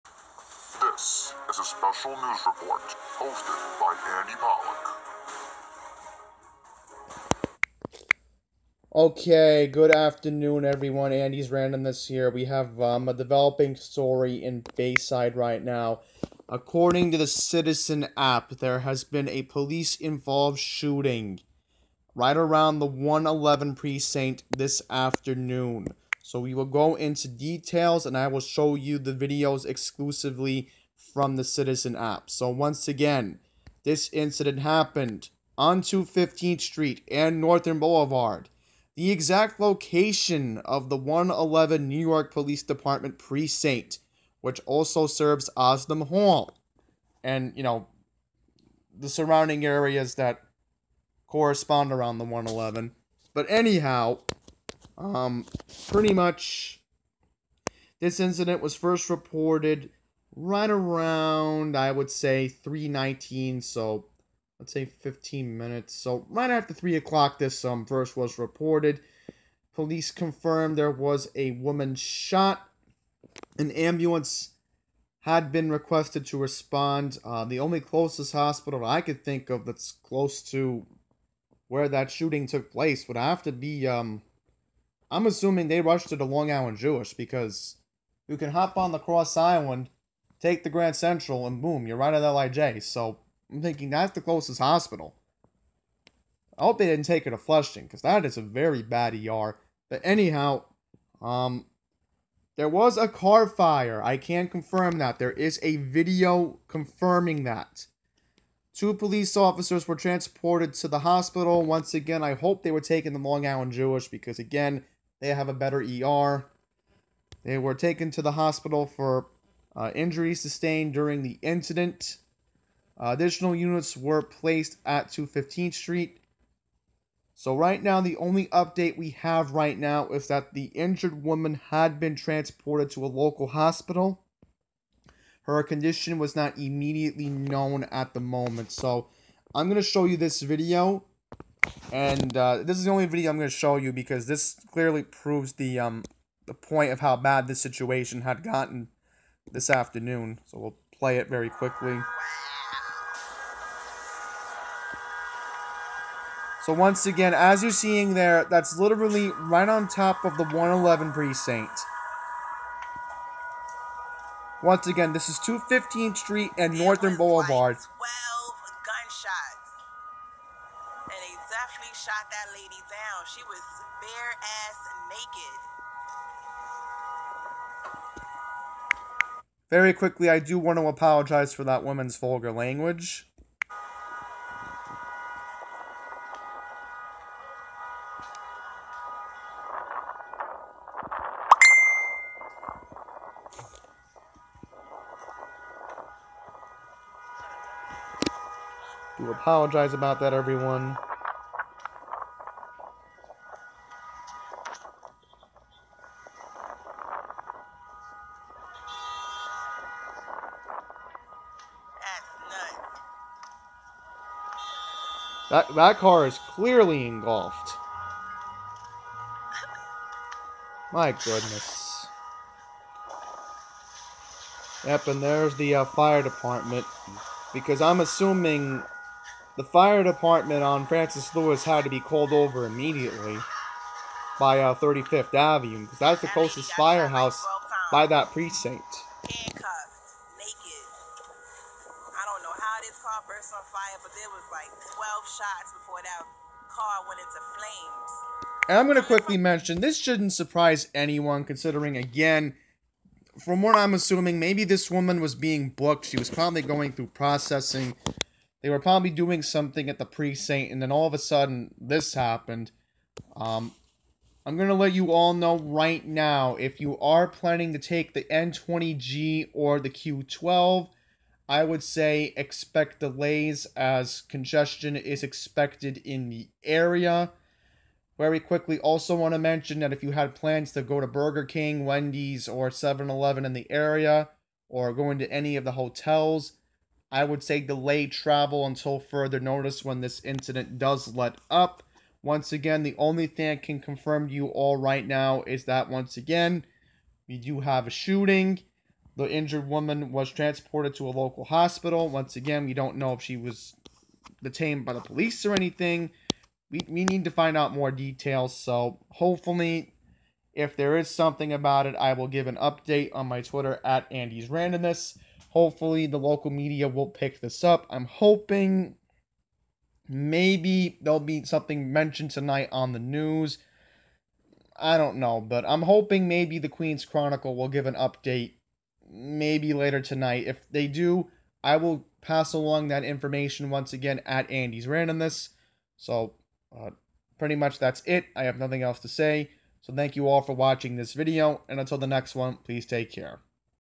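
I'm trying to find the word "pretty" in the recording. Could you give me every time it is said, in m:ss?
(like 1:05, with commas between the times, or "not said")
0:55, 5:37.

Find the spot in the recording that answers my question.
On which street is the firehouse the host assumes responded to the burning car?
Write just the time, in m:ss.
3:50.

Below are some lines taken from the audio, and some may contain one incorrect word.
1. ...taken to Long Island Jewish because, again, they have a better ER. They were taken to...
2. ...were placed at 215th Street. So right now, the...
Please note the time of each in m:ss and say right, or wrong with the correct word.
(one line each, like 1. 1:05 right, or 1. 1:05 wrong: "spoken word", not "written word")
1. 1:52 right
2. 2:03 right.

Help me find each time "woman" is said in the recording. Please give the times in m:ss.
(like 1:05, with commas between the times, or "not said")
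1:11, 2:11, 3:01, 4:14, 4:59.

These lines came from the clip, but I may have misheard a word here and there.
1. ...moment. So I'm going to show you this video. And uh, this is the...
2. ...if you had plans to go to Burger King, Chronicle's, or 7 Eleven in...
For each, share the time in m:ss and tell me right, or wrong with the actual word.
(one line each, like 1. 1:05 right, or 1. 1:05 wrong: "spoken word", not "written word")
1. 2:18 right
2. 4:39 wrong: "Wendy", not "Chronicle".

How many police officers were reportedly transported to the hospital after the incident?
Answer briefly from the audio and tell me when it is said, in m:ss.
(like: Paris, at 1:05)
2, at 1:48.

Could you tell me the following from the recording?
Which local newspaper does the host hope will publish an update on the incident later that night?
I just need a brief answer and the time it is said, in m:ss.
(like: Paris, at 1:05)
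Queens Chronicle, at 5:26.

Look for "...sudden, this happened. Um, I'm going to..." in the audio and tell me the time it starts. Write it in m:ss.
4:21.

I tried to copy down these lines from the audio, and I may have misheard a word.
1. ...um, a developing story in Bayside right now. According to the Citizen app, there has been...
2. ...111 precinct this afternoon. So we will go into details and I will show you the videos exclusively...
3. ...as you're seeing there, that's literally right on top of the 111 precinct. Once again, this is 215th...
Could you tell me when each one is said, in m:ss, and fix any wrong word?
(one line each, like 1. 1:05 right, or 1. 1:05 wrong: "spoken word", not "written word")
1. 0:12 right
2. 0:22 right
3. 2:37 right.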